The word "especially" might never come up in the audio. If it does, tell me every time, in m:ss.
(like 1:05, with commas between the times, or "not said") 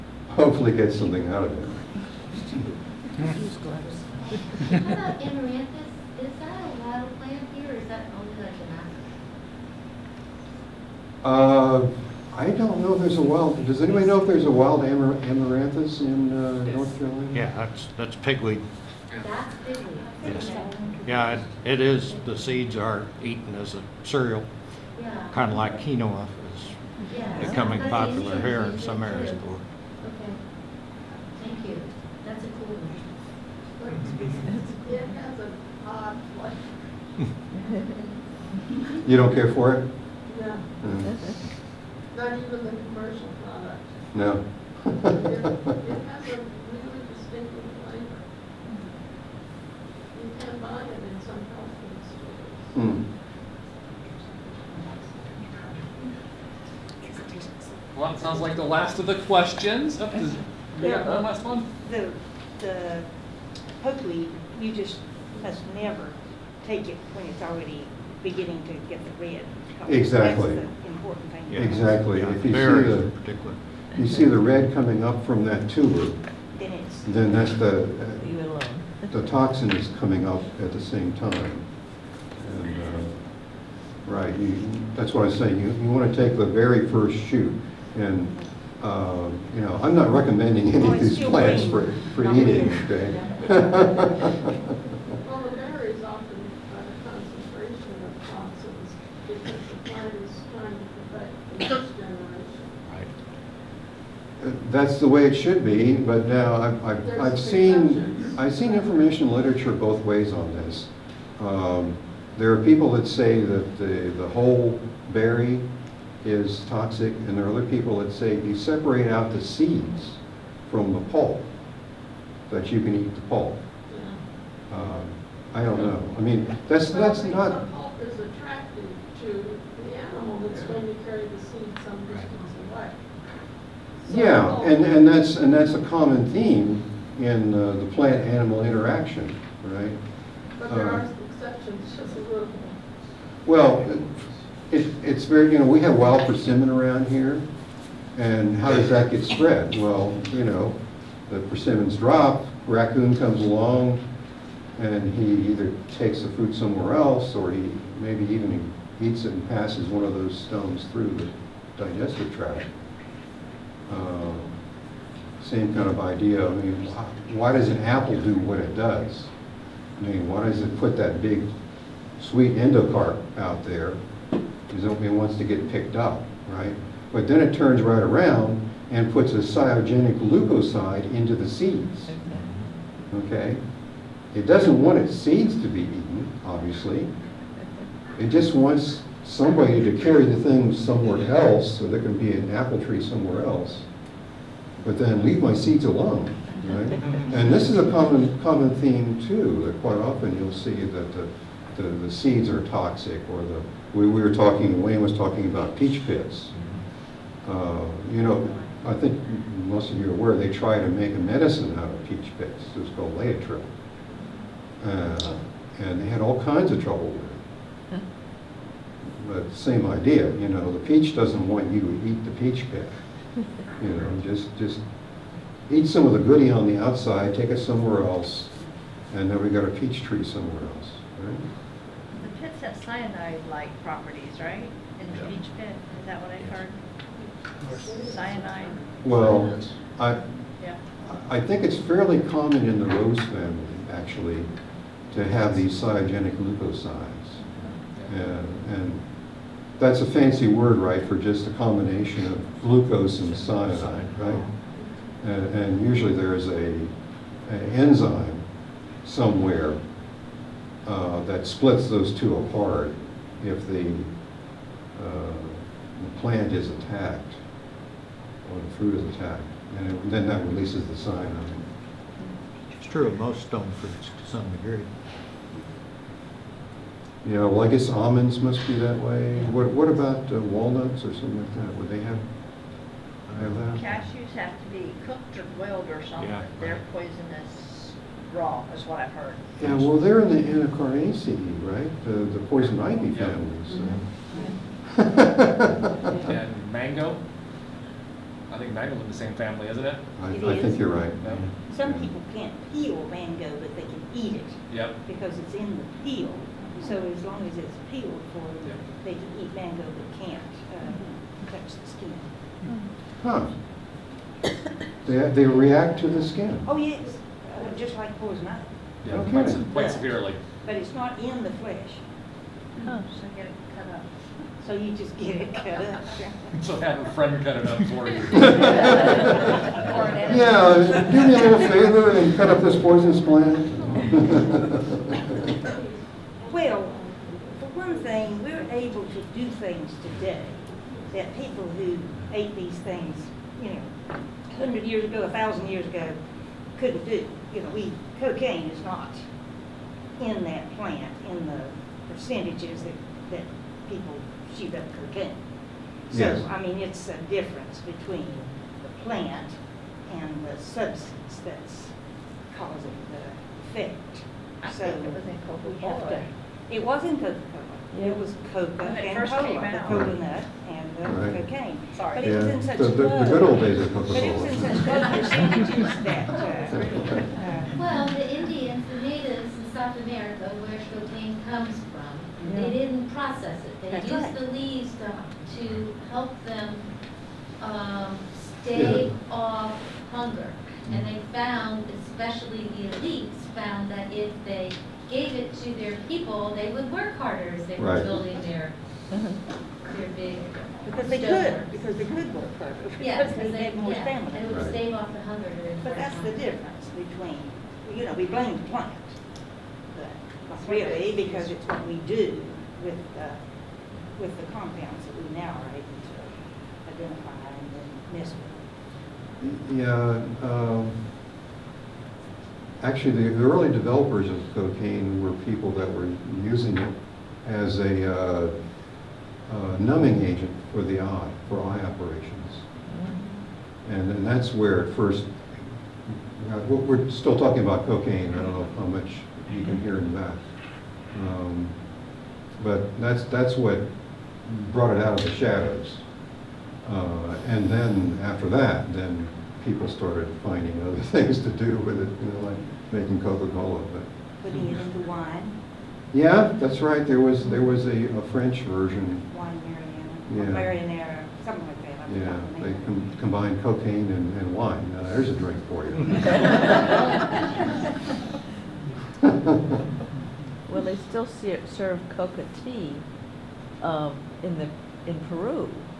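6:32.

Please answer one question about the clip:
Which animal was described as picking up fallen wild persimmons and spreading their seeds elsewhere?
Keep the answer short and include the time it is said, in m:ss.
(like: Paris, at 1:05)
Raccoon, at 2:32.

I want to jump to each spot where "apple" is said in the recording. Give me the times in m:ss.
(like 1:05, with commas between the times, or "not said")
2:47, 3:12.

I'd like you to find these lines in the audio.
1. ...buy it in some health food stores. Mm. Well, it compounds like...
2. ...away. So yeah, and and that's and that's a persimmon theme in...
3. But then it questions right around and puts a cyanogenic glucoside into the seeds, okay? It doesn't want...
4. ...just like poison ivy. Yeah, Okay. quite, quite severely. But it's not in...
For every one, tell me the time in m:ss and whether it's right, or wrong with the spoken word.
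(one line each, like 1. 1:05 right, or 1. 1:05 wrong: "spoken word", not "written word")
1. 0:50 wrong: "sounds", not "compounds"
2. 2:12 wrong: "common", not "persimmon"
3. 2:57 wrong: "turns", not "questions"
4. 5:17 right.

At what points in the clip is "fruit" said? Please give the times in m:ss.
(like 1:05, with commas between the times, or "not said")
2:36, 4:28, 4:33.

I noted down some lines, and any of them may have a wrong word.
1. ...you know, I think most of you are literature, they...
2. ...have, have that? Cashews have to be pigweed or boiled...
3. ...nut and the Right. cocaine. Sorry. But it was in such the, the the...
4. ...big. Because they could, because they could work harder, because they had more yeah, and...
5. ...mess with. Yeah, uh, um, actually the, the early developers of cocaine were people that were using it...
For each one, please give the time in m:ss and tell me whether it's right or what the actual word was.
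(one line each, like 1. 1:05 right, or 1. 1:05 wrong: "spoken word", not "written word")
1. 3:28 wrong: "aware", not "literature"
2. 4:41 wrong: "cooked", not "pigweed"
3. 6:10 right
4. 6:40 right
5. 6:58 right.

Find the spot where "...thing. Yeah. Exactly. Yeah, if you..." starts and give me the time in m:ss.
1:11.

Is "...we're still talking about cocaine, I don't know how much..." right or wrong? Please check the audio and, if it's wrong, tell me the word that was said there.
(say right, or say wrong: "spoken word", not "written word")
right.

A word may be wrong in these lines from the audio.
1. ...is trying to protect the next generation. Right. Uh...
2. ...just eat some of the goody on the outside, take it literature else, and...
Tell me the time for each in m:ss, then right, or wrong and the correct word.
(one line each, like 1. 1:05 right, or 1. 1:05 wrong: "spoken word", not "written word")
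1. 1:40 right
2. 3:44 wrong: "somewhere", not "literature".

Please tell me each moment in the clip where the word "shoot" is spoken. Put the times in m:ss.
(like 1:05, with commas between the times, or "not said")
1:27, 5:54.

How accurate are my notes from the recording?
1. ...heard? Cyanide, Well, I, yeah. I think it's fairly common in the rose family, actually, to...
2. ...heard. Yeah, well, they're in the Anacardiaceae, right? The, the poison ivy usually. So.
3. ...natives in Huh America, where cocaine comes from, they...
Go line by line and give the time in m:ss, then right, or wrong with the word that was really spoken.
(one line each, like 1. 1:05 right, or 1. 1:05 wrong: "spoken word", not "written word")
1. 3:56 right
2. 4:49 wrong: "family", not "usually"
3. 6:19 wrong: "South", not "Huh".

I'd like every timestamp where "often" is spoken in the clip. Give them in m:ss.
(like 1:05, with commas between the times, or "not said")
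1:36, 3:19.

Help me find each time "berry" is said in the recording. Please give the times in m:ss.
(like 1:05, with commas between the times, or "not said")
1:35, 1:55.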